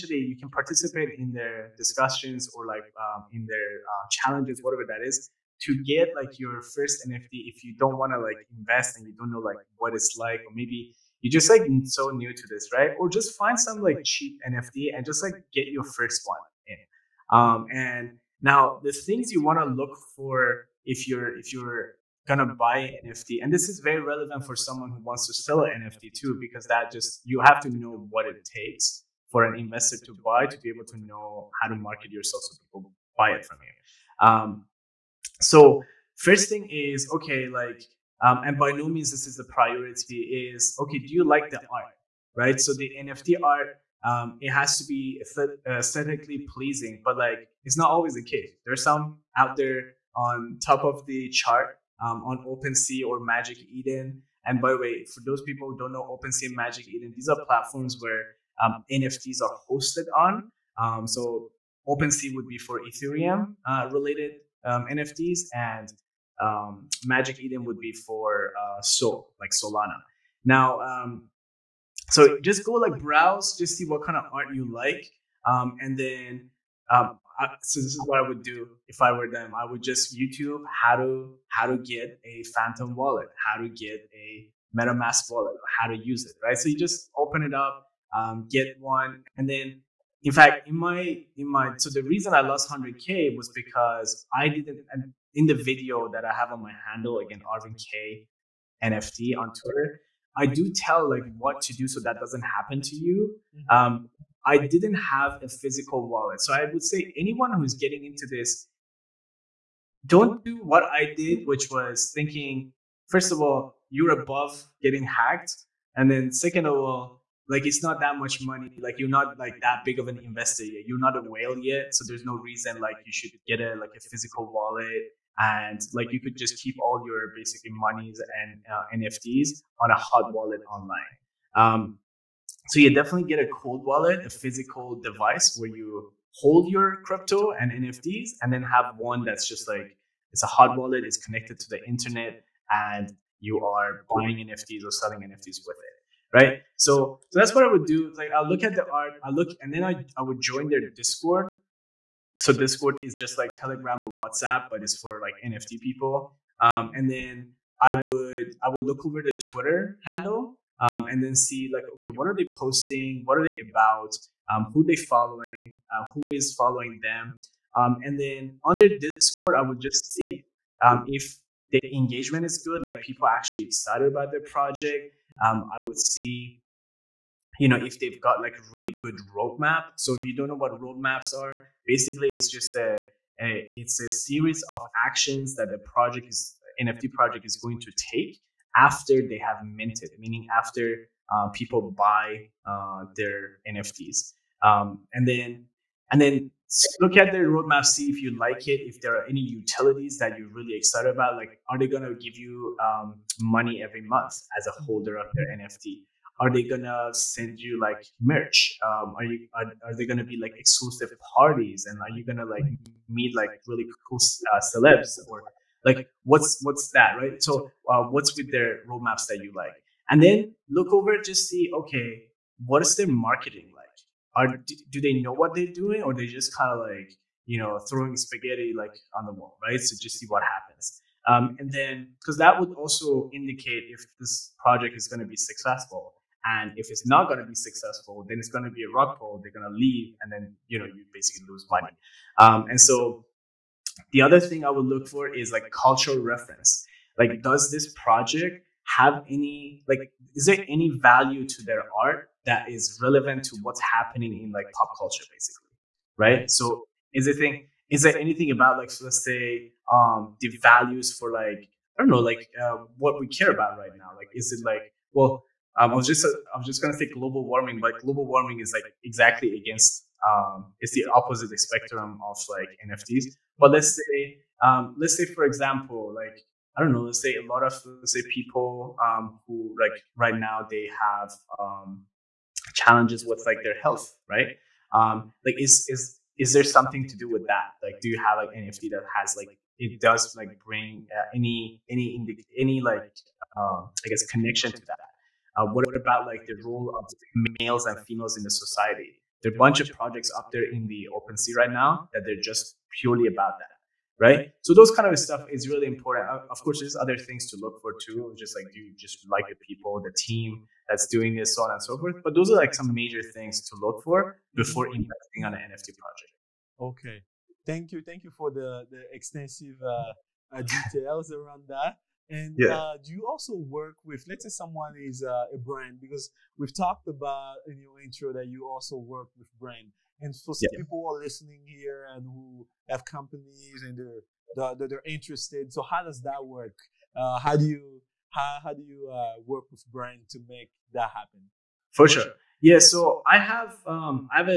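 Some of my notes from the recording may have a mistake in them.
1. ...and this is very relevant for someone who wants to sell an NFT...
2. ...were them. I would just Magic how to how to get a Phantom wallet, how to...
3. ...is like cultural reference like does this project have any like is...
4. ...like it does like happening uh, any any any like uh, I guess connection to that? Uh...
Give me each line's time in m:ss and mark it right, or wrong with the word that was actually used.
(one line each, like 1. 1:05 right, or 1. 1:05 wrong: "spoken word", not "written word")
1. 0:23 right
2. 1:19 wrong: "YouTube", not "Magic"
3. 4:05 right
4. 4:49 wrong: "bring", not "happening".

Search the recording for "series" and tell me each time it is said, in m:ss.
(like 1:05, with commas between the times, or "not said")
3:04.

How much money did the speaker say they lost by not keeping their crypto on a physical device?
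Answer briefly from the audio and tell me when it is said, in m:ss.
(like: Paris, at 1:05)
100k, at 1:32.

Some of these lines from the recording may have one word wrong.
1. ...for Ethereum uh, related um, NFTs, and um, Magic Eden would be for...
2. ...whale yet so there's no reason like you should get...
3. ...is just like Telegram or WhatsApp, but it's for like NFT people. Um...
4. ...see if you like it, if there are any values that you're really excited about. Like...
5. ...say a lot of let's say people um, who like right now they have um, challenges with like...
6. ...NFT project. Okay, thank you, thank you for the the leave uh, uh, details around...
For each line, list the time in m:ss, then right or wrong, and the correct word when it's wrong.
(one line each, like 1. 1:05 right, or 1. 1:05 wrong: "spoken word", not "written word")
1. 1:02 right
2. 2:01 right
3. 2:33 right
4. 3:17 wrong: "utilities", not "values"
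5. 4:37 right
6. 5:15 wrong: "extensive", not "leave".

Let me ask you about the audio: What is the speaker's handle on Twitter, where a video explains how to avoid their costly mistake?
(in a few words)
Arvin K NFT.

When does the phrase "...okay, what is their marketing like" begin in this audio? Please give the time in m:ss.
3:41.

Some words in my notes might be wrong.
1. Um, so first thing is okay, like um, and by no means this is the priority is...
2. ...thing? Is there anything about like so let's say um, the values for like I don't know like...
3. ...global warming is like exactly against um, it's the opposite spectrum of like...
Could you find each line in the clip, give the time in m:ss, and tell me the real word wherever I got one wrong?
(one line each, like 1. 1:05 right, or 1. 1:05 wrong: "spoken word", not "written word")
1. 0:34 right
2. 4:17 right
3. 4:28 right.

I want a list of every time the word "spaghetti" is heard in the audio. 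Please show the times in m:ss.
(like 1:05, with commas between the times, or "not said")
3:48.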